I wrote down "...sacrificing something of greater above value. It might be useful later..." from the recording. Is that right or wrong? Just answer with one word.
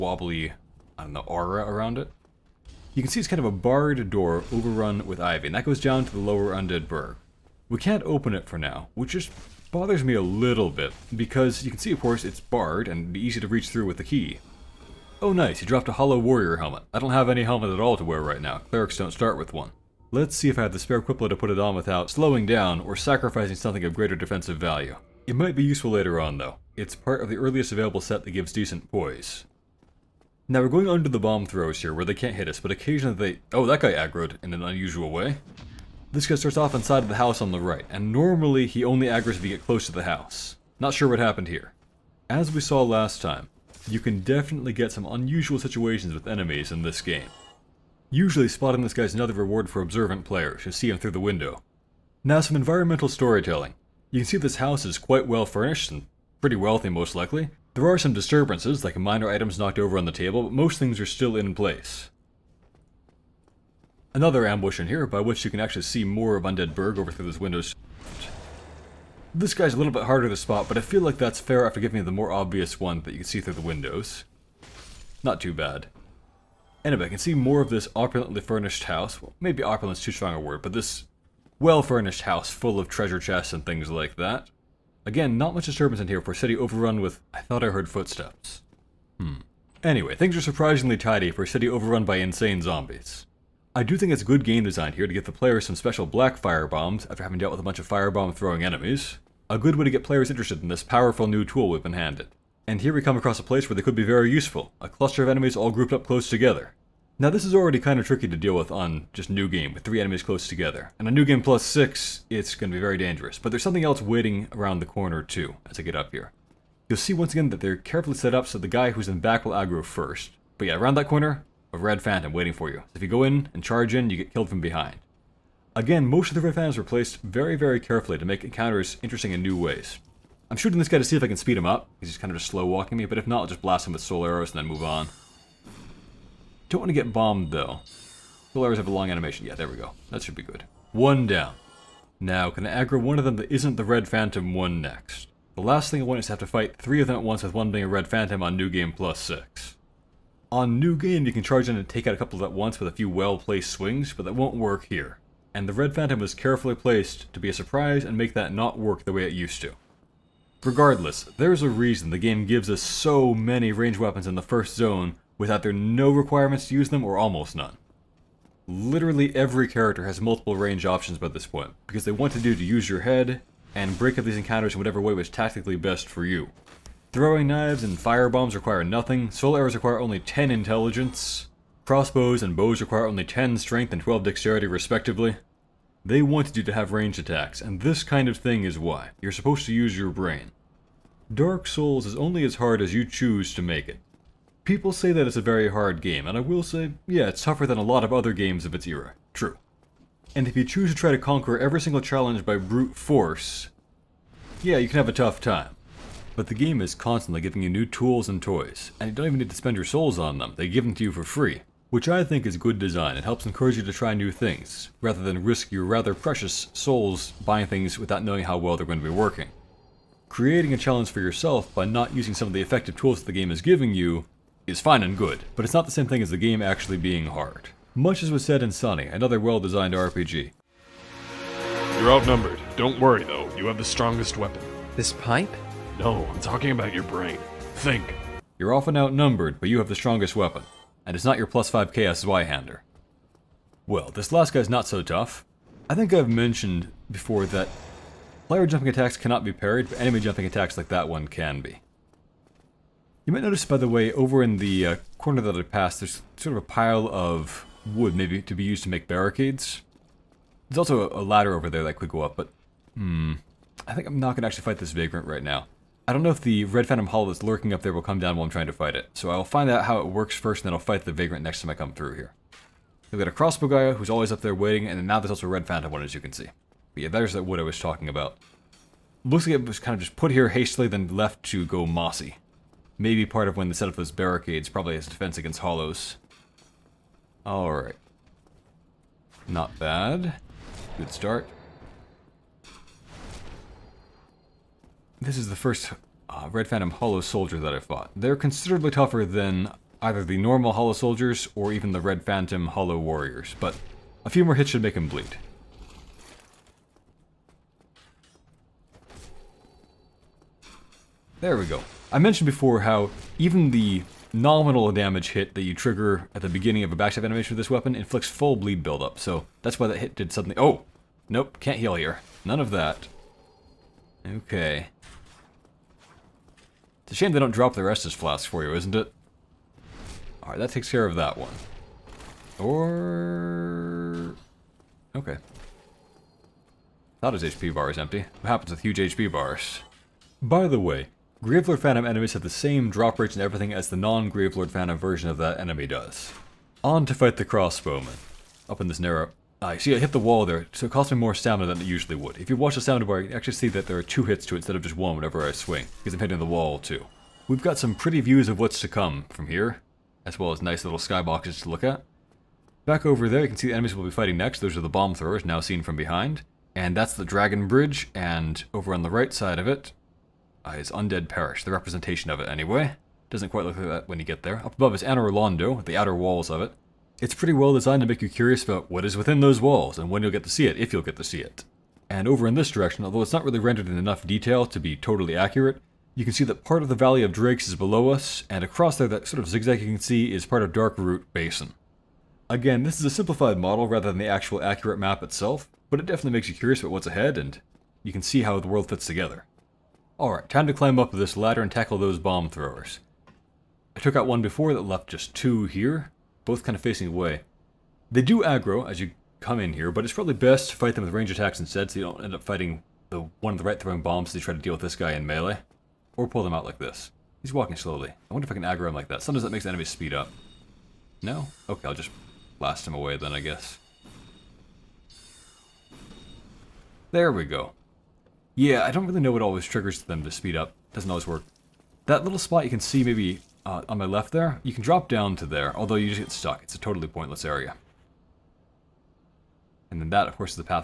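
wrong.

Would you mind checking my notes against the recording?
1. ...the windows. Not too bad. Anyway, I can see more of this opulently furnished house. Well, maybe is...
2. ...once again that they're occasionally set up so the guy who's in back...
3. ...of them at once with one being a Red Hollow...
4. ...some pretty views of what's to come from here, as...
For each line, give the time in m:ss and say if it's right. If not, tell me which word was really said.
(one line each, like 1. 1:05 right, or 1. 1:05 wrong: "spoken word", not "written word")
1. 1:13 right
2. 1:57 wrong: "carefully", not "occasionally"
3. 2:27 wrong: "Phantom", not "Hollow"
4. 5:57 right.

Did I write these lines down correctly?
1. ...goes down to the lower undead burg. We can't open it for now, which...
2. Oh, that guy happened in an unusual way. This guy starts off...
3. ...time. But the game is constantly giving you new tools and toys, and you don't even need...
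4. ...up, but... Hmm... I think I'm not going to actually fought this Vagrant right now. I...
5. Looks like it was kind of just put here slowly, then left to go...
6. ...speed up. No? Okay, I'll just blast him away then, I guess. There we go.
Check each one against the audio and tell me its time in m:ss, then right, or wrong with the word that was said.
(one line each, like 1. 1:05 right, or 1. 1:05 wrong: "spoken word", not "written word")
1. 0:05 right
2. 0:33 wrong: "aggroed", not "happened"
3. 3:25 right
4. 4:22 wrong: "fight", not "fought"
5. 4:39 wrong: "hastily", not "slowly"
6. 6:59 right.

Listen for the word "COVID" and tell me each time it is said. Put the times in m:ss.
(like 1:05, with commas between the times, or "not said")
not said.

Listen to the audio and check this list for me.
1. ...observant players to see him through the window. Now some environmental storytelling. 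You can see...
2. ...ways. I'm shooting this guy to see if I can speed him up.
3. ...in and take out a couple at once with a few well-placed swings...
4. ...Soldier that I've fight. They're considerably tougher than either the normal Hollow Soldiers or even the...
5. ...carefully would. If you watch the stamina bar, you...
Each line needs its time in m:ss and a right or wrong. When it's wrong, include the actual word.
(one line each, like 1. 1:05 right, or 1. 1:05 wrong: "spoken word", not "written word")
1. 0:49 right
2. 2:09 right
3. 2:31 right
4. 4:57 wrong: "fought", not "fight"
5. 5:51 wrong: "usually", not "carefully".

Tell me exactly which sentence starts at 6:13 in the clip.
Doesn't quite look like that when you get there.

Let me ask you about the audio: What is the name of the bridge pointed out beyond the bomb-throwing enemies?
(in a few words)
Dragon Bridge.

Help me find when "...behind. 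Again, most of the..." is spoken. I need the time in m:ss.
2:04.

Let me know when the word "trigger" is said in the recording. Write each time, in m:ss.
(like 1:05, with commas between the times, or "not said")
5:15, 7:09.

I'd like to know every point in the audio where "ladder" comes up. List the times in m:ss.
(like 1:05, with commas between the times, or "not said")
4:21, 6:41.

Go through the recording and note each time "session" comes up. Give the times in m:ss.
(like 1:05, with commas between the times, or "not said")
not said.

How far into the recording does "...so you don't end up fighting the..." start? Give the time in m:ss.
6:51.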